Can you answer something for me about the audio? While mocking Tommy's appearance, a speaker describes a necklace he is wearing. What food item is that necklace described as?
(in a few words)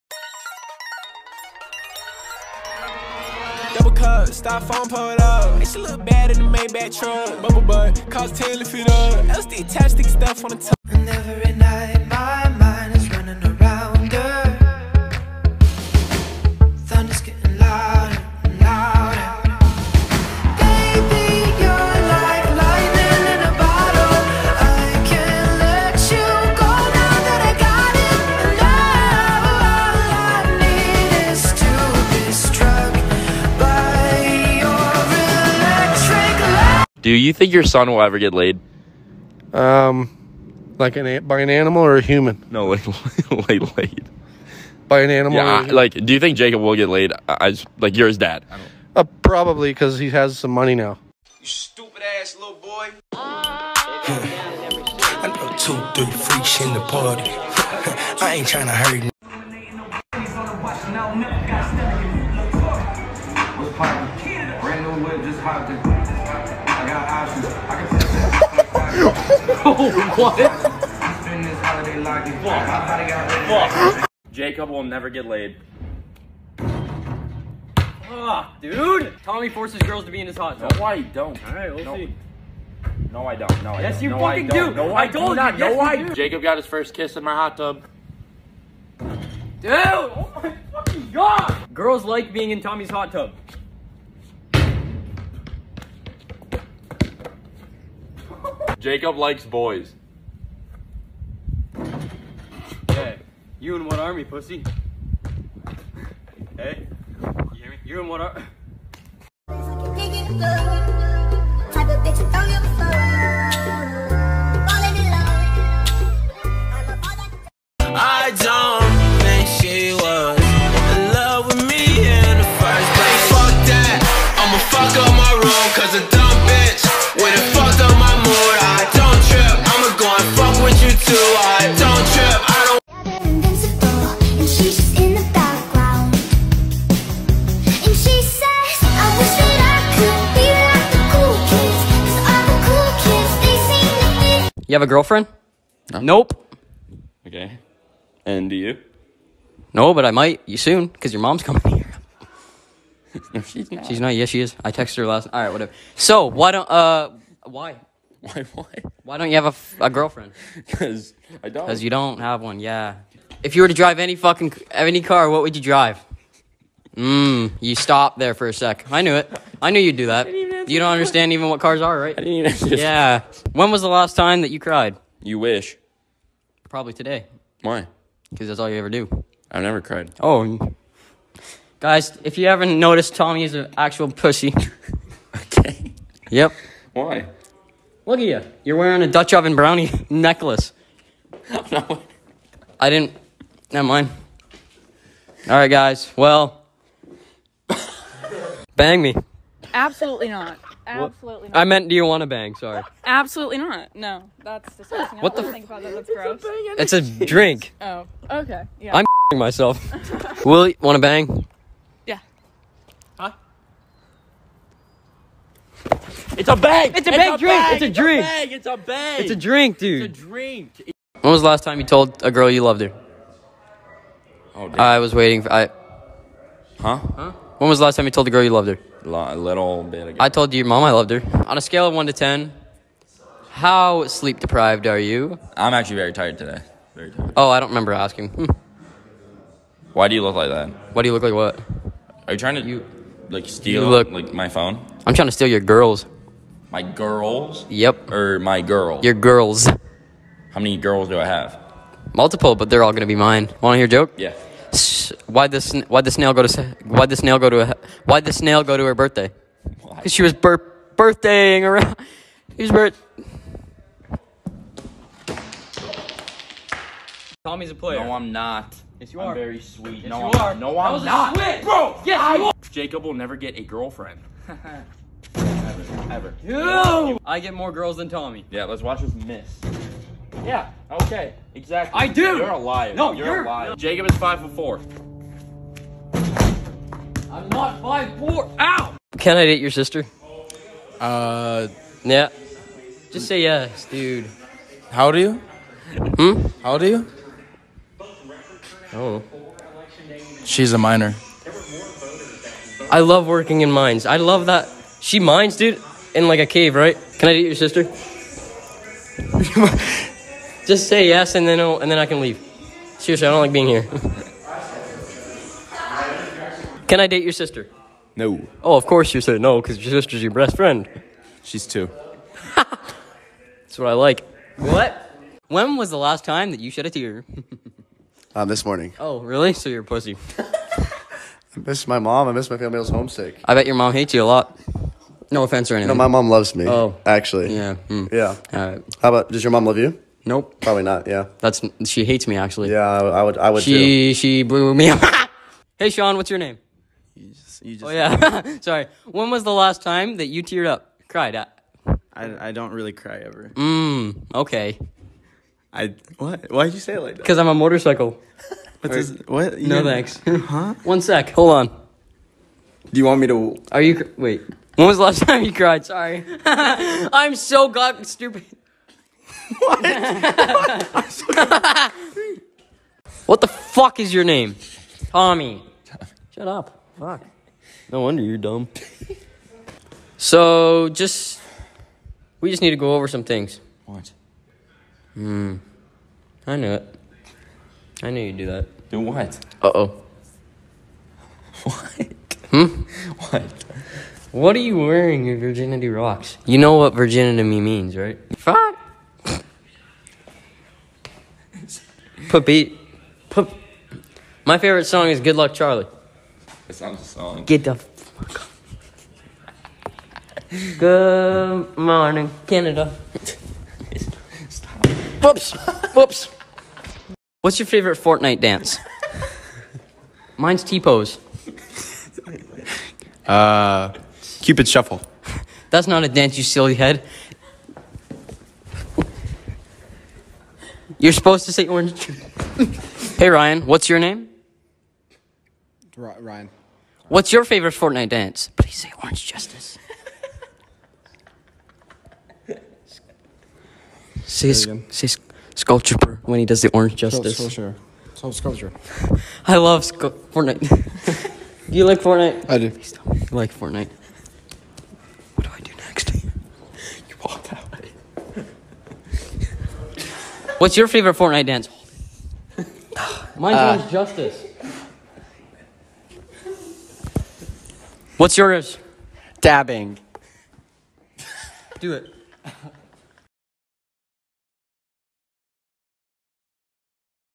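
Dutch oven brownie.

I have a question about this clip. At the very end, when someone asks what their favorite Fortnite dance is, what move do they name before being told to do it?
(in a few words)
Dabbing.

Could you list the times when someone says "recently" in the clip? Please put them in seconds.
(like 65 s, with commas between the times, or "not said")
not said.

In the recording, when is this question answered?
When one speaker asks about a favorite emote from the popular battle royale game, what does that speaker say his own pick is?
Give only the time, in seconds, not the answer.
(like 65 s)
420 s.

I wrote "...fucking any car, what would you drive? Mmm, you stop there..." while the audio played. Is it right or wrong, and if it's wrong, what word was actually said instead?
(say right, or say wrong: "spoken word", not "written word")
right.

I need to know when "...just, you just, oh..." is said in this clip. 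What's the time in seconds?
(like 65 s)
347 s.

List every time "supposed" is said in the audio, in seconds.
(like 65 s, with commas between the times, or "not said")
431 s.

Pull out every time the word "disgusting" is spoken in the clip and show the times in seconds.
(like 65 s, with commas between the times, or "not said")
204 s.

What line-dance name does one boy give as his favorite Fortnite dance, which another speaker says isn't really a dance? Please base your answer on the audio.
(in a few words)
Cupid Shuffle.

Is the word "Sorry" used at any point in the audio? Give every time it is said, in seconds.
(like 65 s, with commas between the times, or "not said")
202 s, 348 s, 365 s.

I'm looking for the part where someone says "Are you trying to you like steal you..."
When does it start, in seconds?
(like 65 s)
242 s.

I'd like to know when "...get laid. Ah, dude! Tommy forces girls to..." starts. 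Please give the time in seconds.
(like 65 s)
75 s.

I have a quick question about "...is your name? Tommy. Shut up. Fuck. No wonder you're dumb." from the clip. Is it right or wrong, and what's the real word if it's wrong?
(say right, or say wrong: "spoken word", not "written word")
right.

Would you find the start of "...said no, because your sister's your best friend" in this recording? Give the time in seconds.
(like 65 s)
319 s.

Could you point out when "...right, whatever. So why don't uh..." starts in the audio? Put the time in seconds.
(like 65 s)
155 s.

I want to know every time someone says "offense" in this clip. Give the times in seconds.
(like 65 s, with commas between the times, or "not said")
335 s.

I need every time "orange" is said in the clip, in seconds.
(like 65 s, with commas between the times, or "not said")
431 s, 439 s, 446 s.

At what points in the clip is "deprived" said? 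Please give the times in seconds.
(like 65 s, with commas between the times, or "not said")
234 s.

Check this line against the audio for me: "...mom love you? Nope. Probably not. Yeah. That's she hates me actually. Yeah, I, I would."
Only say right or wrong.
right.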